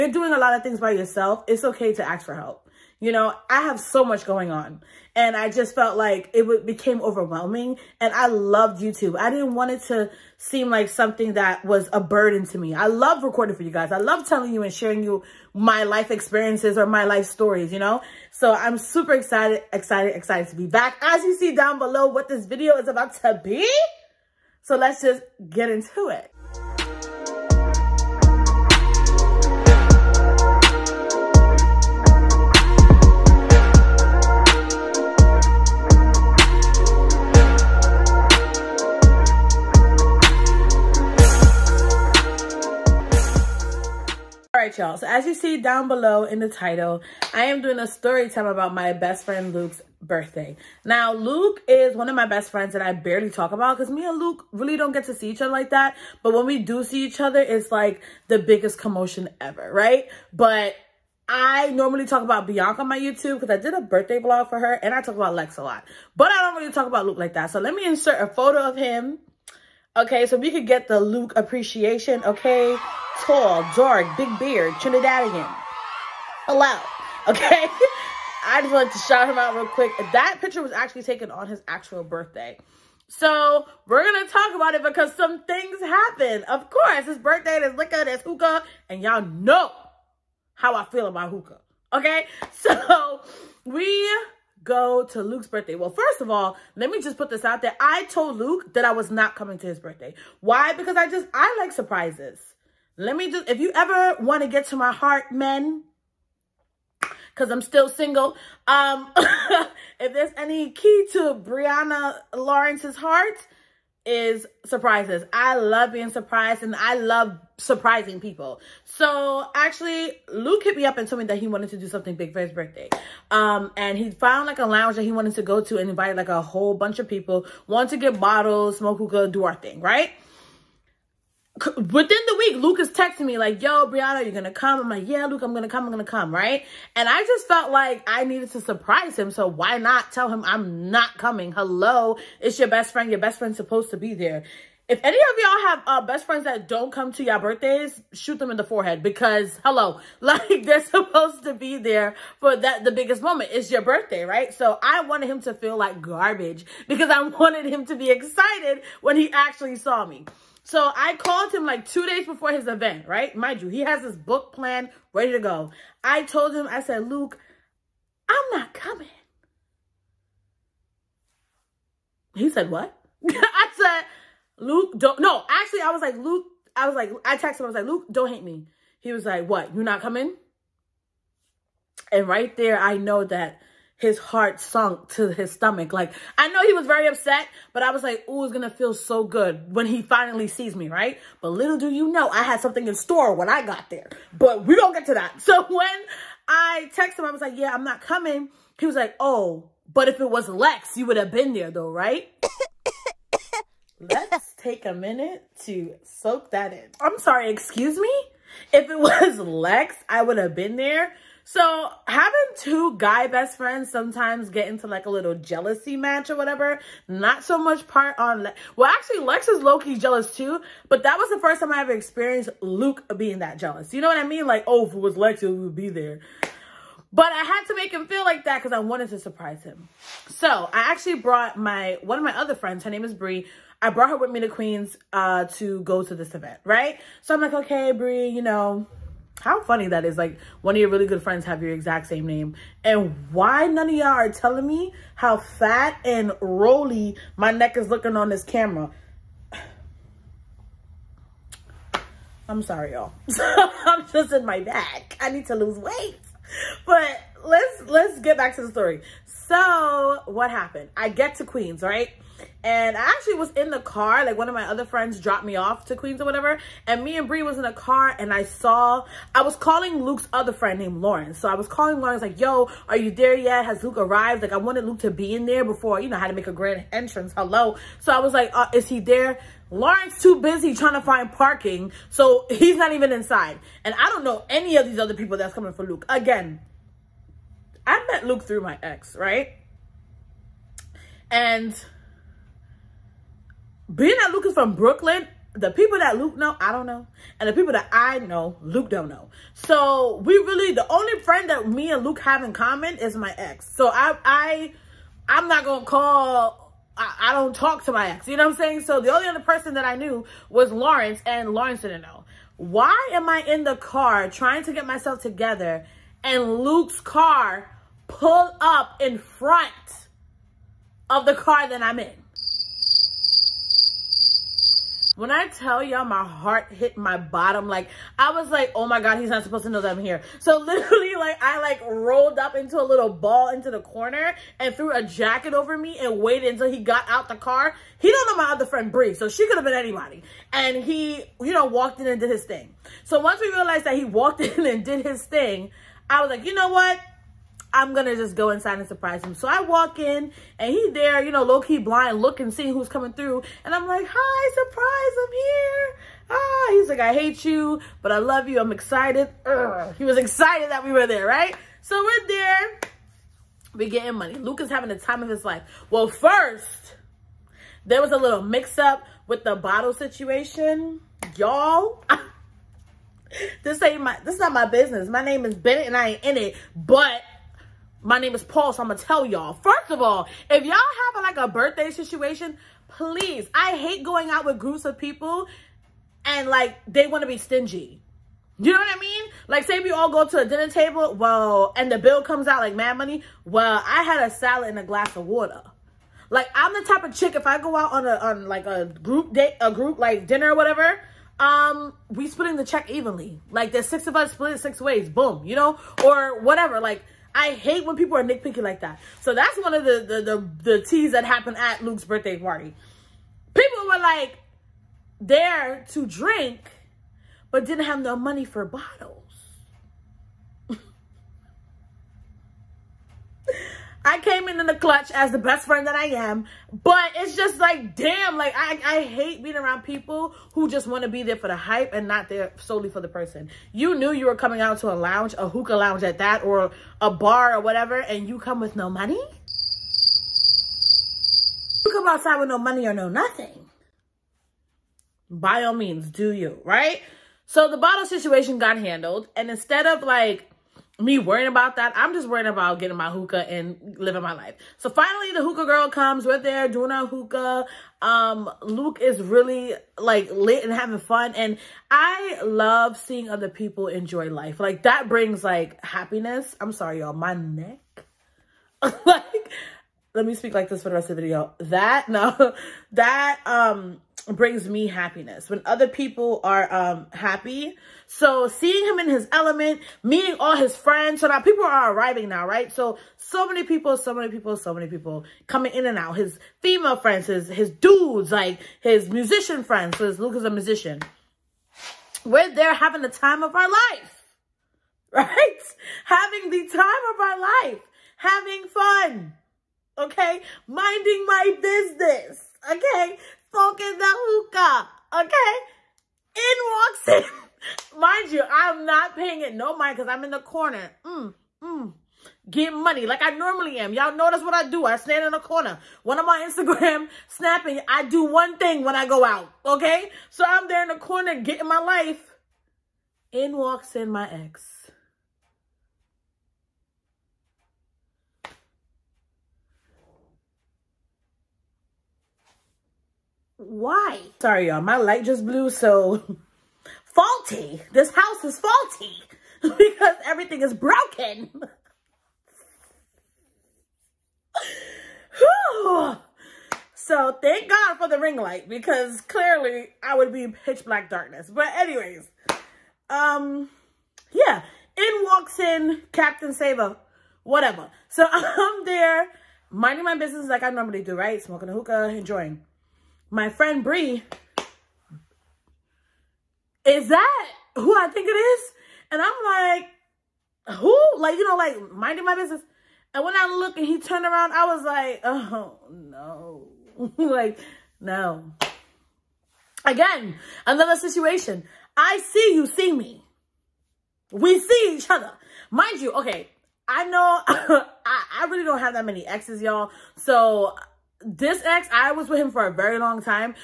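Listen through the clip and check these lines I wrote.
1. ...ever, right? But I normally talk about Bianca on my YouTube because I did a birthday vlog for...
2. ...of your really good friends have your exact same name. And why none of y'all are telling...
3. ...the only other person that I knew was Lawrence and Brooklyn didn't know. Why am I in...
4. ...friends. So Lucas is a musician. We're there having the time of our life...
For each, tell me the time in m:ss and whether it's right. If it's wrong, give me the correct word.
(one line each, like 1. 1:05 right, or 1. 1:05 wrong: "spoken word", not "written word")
1. 0:59 right
2. 4:00 right
3. 5:08 wrong: "Lawrence", not "Brooklyn"
4. 8:09 wrong: "Luke", not "Lucas".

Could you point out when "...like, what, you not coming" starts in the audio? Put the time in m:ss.
2:59.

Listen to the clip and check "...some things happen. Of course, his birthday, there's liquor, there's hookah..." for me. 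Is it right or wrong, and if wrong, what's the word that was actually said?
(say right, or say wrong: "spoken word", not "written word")
right.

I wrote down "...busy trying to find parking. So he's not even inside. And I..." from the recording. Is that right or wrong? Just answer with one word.
right.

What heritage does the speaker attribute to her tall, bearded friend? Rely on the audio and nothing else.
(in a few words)
Trinidadian.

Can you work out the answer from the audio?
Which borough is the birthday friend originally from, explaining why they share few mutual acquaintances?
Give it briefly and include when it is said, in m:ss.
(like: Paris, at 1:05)
Brooklyn, at 4:54.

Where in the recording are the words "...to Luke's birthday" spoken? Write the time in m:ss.
1:35.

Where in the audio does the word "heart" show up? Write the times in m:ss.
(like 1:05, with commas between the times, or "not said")
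1:44, 1:52, 3:04, 5:26.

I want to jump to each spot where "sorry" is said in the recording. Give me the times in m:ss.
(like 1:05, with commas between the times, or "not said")
3:27, 4:12, 7:46, 8:54.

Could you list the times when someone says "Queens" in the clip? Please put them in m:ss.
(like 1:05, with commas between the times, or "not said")
3:54, 4:21, 4:25.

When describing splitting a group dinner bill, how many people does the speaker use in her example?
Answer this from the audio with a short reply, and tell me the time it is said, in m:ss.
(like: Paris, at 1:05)
6, at 6:43.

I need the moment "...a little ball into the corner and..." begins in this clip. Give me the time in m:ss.
5:32.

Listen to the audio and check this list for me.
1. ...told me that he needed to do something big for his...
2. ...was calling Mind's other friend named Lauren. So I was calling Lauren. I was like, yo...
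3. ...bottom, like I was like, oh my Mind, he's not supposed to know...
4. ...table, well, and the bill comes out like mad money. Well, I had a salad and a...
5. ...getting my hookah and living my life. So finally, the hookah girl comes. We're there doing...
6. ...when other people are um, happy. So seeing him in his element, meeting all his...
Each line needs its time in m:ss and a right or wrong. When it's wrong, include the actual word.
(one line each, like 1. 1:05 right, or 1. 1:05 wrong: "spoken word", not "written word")
1. 2:01 wrong: "wanted", not "needed"
2. 4:29 wrong: "Luke", not "Mind"
3. 5:27 wrong: "God", not "Mind"
4. 6:30 right
5. 7:32 right
6. 7:55 right.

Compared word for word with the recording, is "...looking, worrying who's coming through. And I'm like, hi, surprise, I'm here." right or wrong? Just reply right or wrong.
wrong.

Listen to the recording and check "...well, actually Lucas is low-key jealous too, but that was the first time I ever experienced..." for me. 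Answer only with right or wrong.
wrong.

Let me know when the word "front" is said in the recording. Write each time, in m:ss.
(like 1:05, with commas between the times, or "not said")
5:19.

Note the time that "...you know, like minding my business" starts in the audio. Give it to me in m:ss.
9:31.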